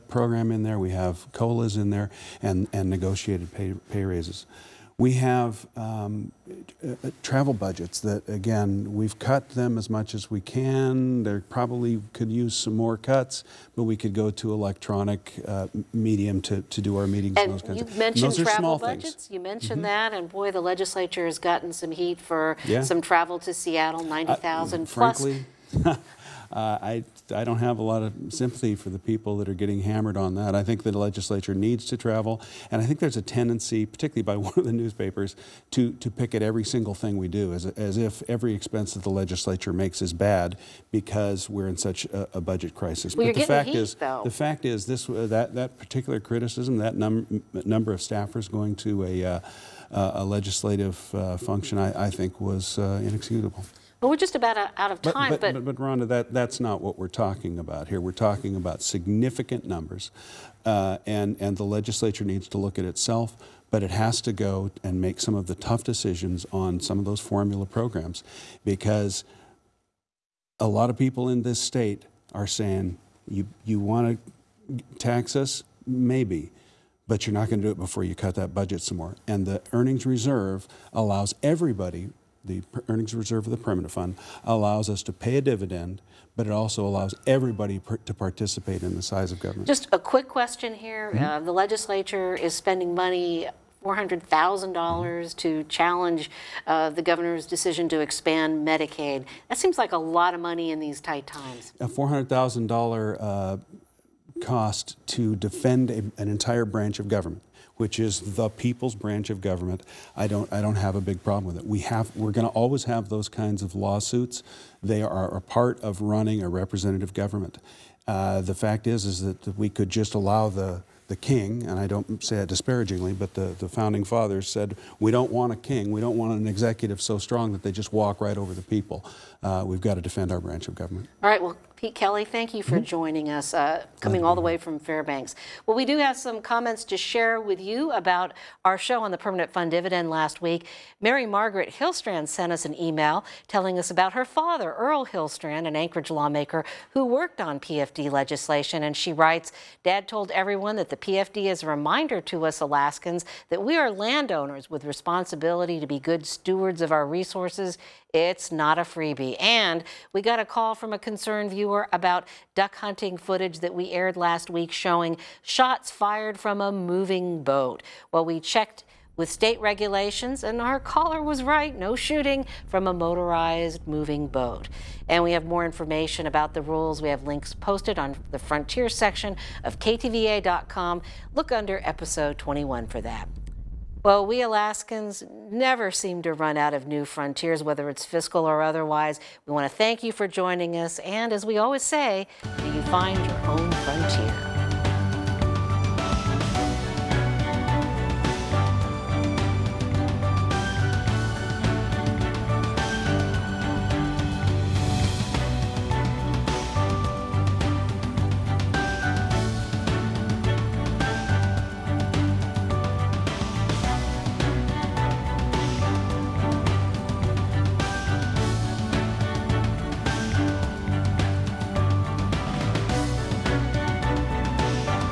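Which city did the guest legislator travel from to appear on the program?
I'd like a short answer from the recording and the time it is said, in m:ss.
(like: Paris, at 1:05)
Fairbanks, at 2:14.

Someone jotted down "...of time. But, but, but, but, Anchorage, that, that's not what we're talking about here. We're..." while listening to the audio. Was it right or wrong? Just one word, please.
wrong.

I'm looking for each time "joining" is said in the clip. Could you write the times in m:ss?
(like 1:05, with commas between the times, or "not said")
2:12, 3:10.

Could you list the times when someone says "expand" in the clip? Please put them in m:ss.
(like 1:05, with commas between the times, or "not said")
1:37.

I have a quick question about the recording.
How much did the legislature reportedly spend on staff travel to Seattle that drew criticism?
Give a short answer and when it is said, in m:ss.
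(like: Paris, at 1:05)
90,000, at 0:24.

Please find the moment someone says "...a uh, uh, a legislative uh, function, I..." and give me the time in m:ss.
0:49.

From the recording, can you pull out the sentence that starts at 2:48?
Well, we checked with state regulations, and our caller was right no shooting from a motorized moving boat.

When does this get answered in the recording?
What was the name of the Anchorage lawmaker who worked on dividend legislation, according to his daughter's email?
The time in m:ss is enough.
2:24.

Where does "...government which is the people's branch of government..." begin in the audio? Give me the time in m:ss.
1:47.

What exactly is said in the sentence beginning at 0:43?
Well, but the fact heat, is, though.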